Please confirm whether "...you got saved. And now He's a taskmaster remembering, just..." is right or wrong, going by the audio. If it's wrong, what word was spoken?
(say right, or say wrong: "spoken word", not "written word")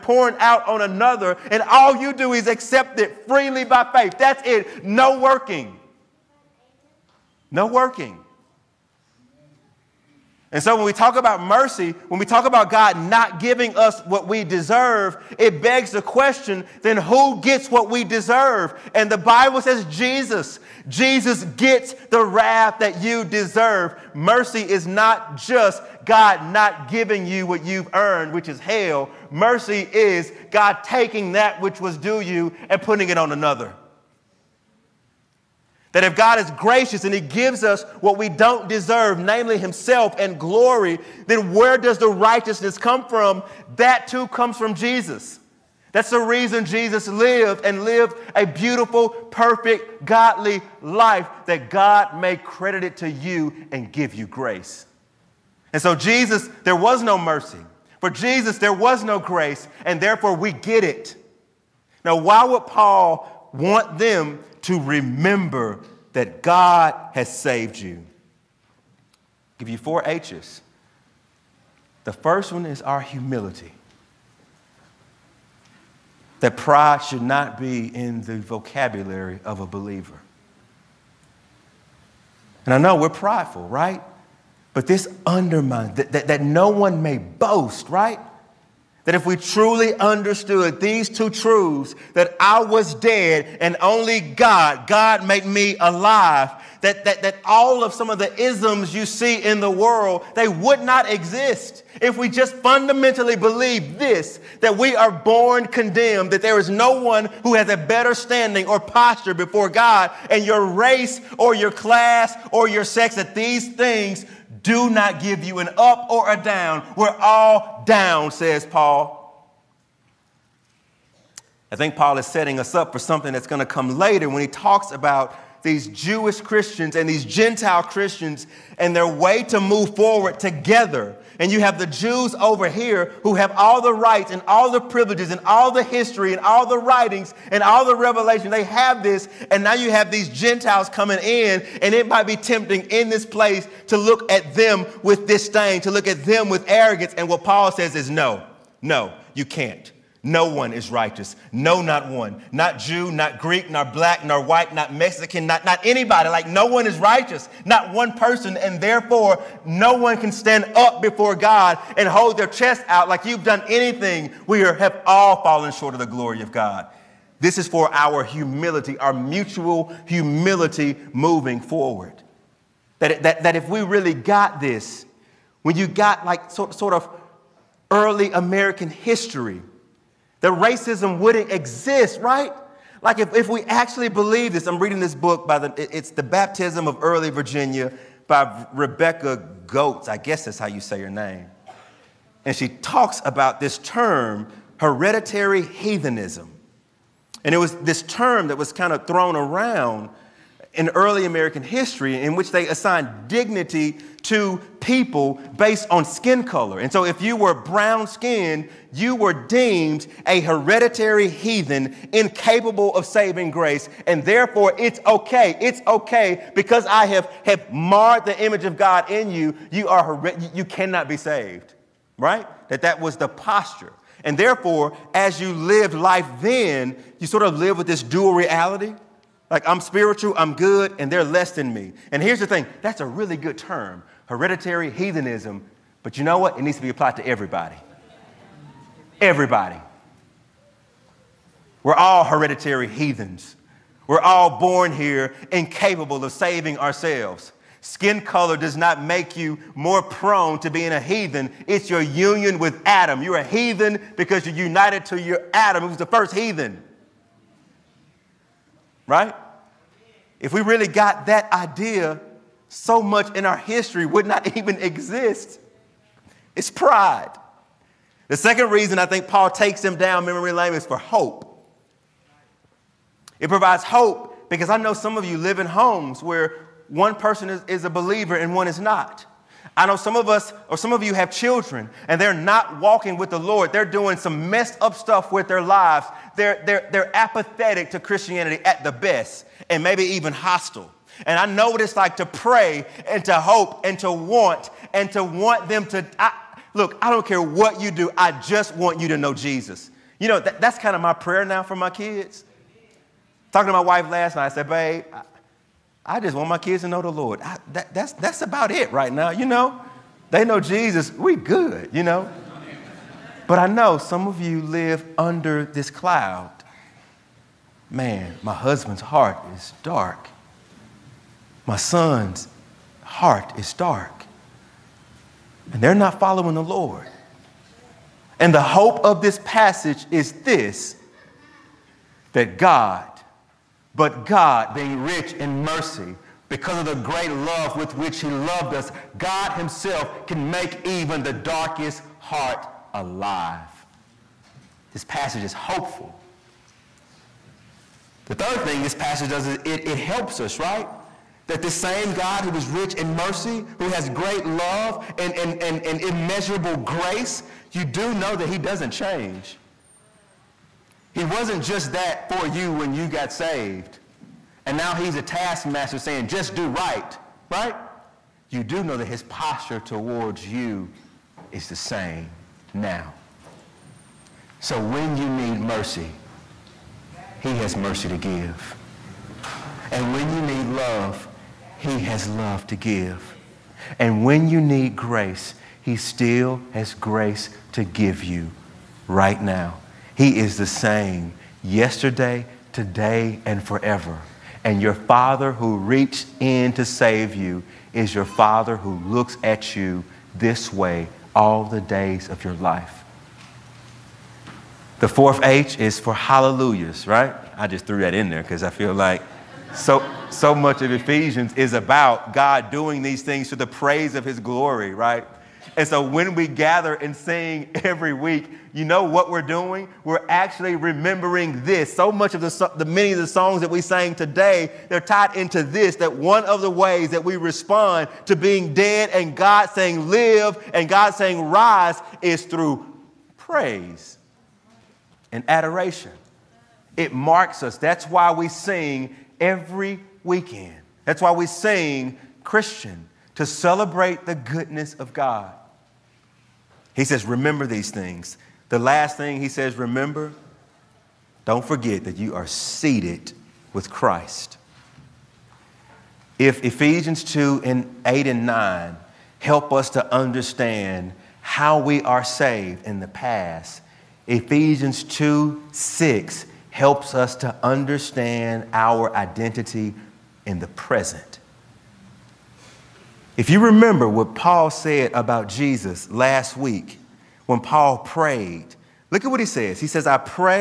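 wrong: "saying", not "remembering".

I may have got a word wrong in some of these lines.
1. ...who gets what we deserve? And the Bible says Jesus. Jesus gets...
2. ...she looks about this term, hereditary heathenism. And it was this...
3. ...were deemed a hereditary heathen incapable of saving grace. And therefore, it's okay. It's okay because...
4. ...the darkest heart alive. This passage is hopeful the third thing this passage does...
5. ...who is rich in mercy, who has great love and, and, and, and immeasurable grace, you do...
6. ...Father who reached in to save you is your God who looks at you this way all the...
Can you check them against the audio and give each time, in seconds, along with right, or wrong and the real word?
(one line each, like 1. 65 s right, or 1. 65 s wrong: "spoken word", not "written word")
1. 16 s right
2. 192 s wrong: "talks", not "looks"
3. 209 s right
4. 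341 s right
5. 352 s right
6. 394 s wrong: "Father", not "God".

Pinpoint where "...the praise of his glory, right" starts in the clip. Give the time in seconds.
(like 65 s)
413 s.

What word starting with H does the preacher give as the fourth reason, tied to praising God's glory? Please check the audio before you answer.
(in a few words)
hallelujahs.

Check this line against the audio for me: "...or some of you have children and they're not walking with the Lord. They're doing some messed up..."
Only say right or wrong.
right.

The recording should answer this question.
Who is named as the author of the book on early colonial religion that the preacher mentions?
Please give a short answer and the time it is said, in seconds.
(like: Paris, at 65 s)
Rebecca Goetz, at 188 s.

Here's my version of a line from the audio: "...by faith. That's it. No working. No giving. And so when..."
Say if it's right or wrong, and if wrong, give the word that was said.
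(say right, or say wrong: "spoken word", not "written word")
wrong: "working", not "giving".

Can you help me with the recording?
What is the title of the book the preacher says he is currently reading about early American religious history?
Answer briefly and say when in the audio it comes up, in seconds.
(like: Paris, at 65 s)
The Baptism of Early Virginia, at 186 s.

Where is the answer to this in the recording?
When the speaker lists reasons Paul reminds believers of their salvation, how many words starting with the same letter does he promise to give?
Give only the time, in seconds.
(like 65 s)
69 s.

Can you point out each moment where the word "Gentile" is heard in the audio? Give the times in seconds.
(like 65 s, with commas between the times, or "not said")
127 s, 140 s.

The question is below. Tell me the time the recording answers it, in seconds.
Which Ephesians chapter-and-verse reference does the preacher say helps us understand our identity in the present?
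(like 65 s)
464 s.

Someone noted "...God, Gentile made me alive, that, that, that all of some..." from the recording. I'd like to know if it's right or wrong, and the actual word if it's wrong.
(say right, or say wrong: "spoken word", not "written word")
wrong: "God", not "Gentile".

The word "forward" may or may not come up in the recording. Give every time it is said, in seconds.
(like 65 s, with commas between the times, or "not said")
129 s, 171 s.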